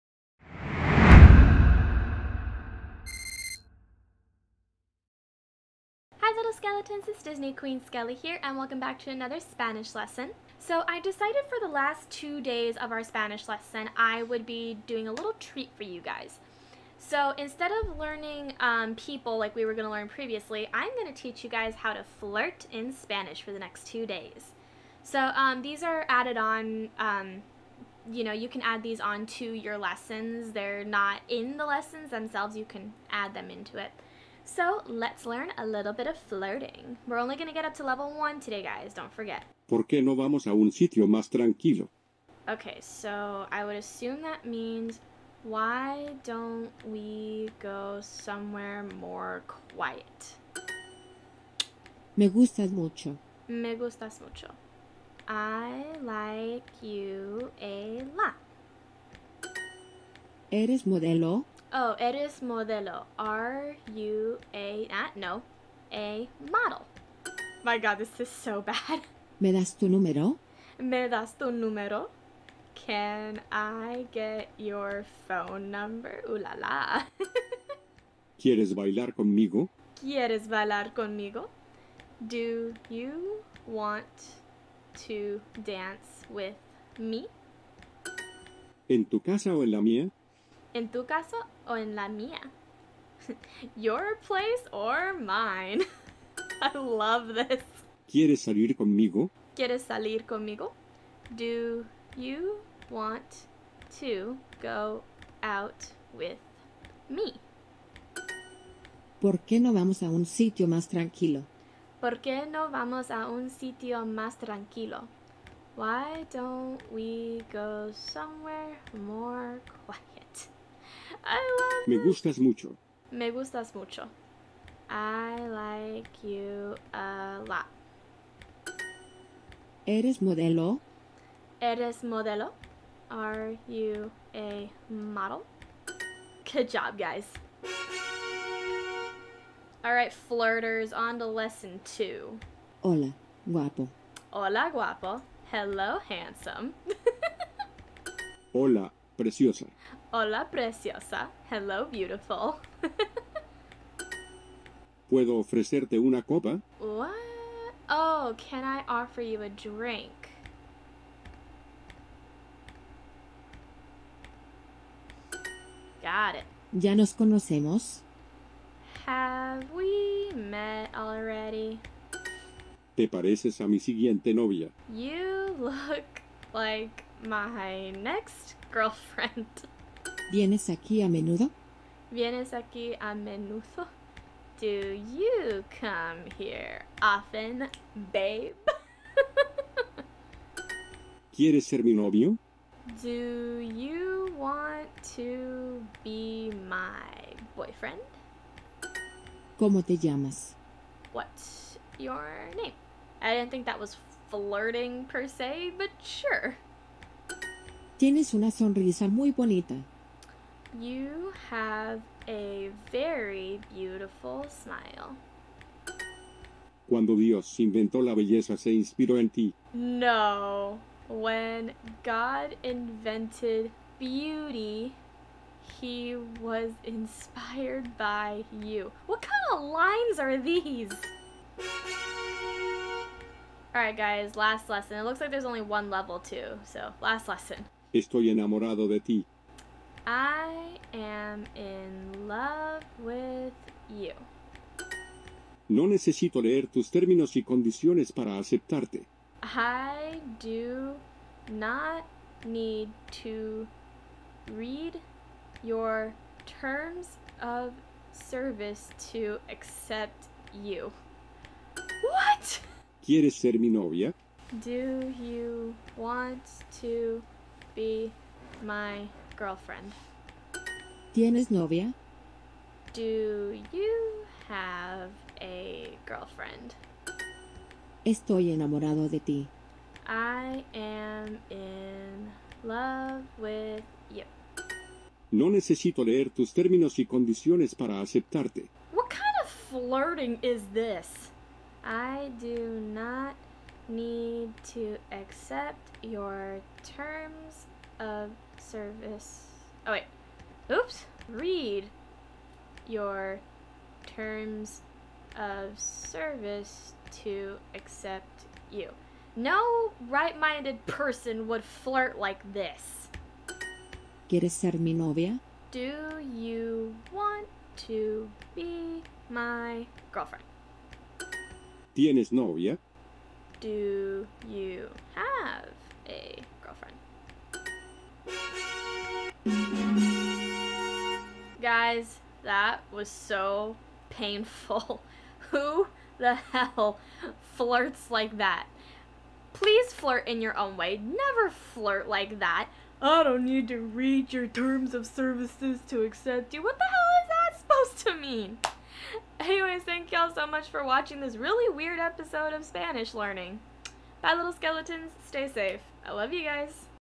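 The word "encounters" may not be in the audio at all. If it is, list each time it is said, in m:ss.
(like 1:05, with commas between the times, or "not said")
not said.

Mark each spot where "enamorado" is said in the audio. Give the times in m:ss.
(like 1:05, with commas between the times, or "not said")
3:58, 4:38.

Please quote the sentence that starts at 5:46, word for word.
What the hell is that supposed to mean?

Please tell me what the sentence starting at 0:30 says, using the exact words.
They're not in the lessons themselves, you can add them into it.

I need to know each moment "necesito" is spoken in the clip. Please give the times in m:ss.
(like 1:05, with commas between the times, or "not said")
4:05, 4:45.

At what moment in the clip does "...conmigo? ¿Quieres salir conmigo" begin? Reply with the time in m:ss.
1:38.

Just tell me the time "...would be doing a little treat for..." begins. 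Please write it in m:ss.
0:14.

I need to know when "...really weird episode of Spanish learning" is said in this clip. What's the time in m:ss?
5:51.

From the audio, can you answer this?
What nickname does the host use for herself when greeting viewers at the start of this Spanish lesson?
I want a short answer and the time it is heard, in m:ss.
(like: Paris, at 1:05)
Disney Queen Skelly, at 0:07.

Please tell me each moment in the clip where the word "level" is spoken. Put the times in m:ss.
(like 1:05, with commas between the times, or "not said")
0:37, 3:55.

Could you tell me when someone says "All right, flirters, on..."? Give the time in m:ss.
2:19.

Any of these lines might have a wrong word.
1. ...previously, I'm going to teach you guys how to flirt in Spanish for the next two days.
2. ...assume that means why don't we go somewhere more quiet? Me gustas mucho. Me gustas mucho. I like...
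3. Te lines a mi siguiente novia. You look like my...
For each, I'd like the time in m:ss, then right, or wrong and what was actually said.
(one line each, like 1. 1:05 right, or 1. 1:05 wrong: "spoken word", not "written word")
1. 0:20 right
2. 0:43 right
3. 2:52 wrong: "pareces", not "lines".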